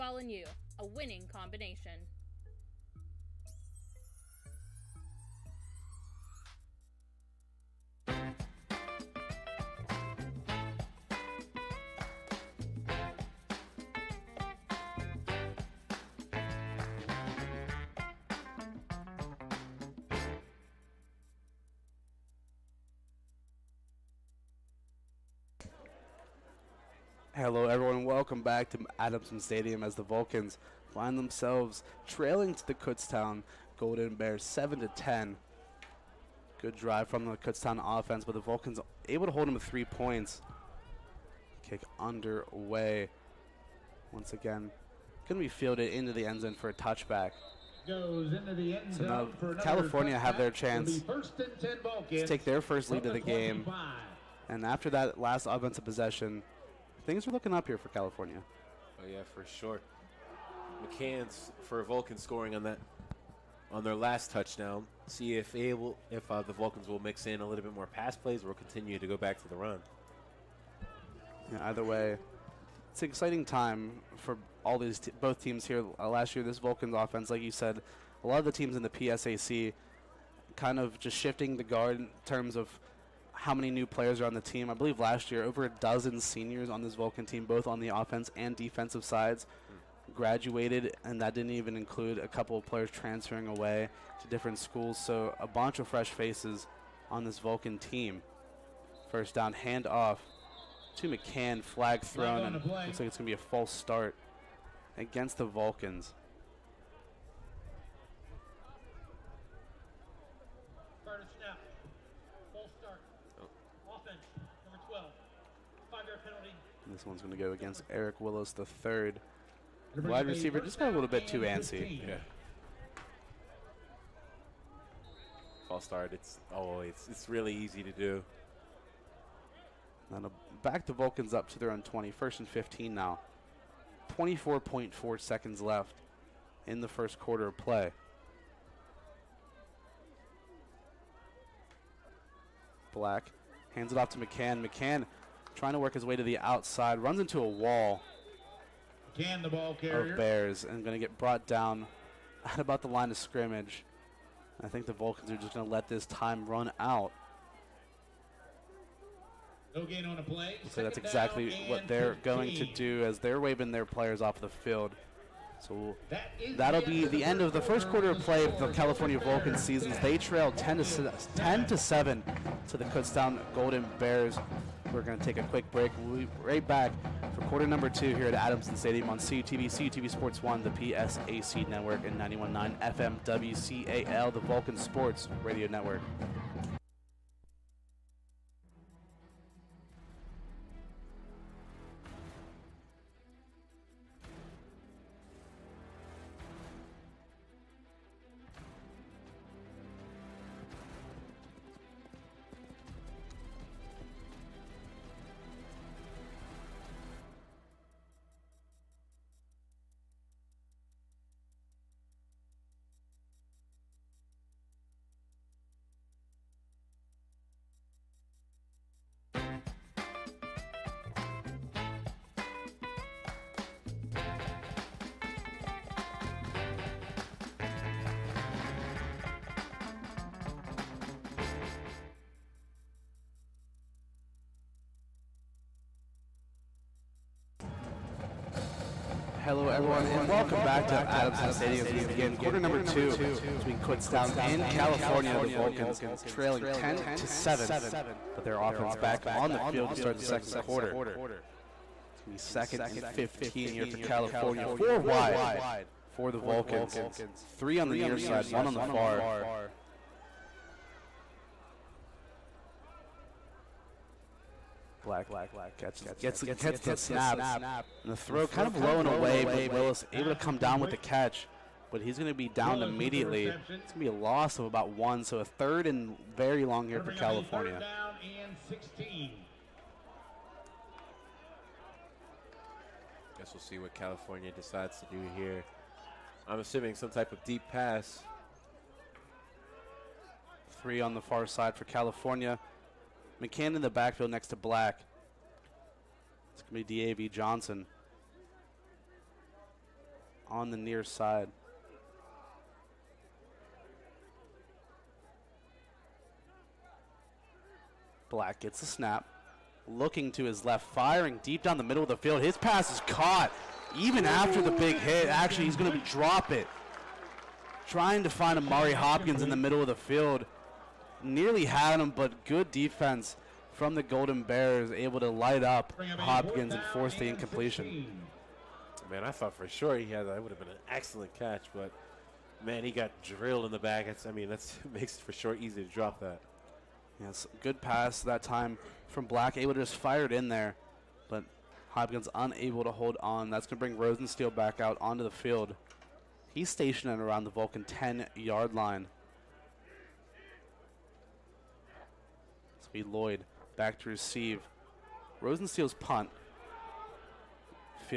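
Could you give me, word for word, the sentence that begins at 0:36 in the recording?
Good drive from the Kutztown offense, but the Vulcans able to hold them to three points.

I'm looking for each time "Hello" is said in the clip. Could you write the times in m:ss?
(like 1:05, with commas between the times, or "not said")
0:27, 3:59.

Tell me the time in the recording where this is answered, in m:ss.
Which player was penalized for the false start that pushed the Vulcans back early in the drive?
1:57.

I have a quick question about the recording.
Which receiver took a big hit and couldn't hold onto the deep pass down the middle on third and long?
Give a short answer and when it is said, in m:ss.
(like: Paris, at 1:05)
Amari Hopkins, at 5:18.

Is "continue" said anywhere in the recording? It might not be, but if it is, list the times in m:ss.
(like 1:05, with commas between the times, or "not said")
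1:08.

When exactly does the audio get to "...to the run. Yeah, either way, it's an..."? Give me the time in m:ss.
1:09.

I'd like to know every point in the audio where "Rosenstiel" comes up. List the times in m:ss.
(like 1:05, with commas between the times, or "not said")
5:43, 5:55.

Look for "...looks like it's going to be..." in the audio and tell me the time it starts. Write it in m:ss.
1:42.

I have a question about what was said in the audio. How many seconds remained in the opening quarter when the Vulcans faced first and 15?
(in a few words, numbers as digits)
24.4.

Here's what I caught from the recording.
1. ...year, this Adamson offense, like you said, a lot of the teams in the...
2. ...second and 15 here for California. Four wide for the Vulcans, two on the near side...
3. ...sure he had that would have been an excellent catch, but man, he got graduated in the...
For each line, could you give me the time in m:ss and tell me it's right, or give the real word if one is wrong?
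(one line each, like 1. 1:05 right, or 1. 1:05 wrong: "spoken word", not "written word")
1. 1:16 wrong: "Vulcans", not "Adamson"
2. 4:12 wrong: "three", not "two"
3. 5:29 wrong: "drilled", not "graduated".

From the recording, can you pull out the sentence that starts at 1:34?
So a bunch of fresh faces on this Vulcan team.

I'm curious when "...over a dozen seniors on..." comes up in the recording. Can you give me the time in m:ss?
1:25.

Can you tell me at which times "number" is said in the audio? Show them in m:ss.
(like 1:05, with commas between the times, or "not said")
2:57, 4:02.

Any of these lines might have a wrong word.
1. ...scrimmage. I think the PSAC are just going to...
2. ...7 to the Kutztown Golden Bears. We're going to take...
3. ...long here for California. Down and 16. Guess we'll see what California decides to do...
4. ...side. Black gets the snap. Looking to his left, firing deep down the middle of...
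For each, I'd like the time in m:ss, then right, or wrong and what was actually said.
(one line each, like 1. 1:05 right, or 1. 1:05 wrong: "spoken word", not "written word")
1. 2:33 wrong: "Vulcans", not "PSAC"
2. 2:51 right
3. 4:36 right
4. 5:01 right.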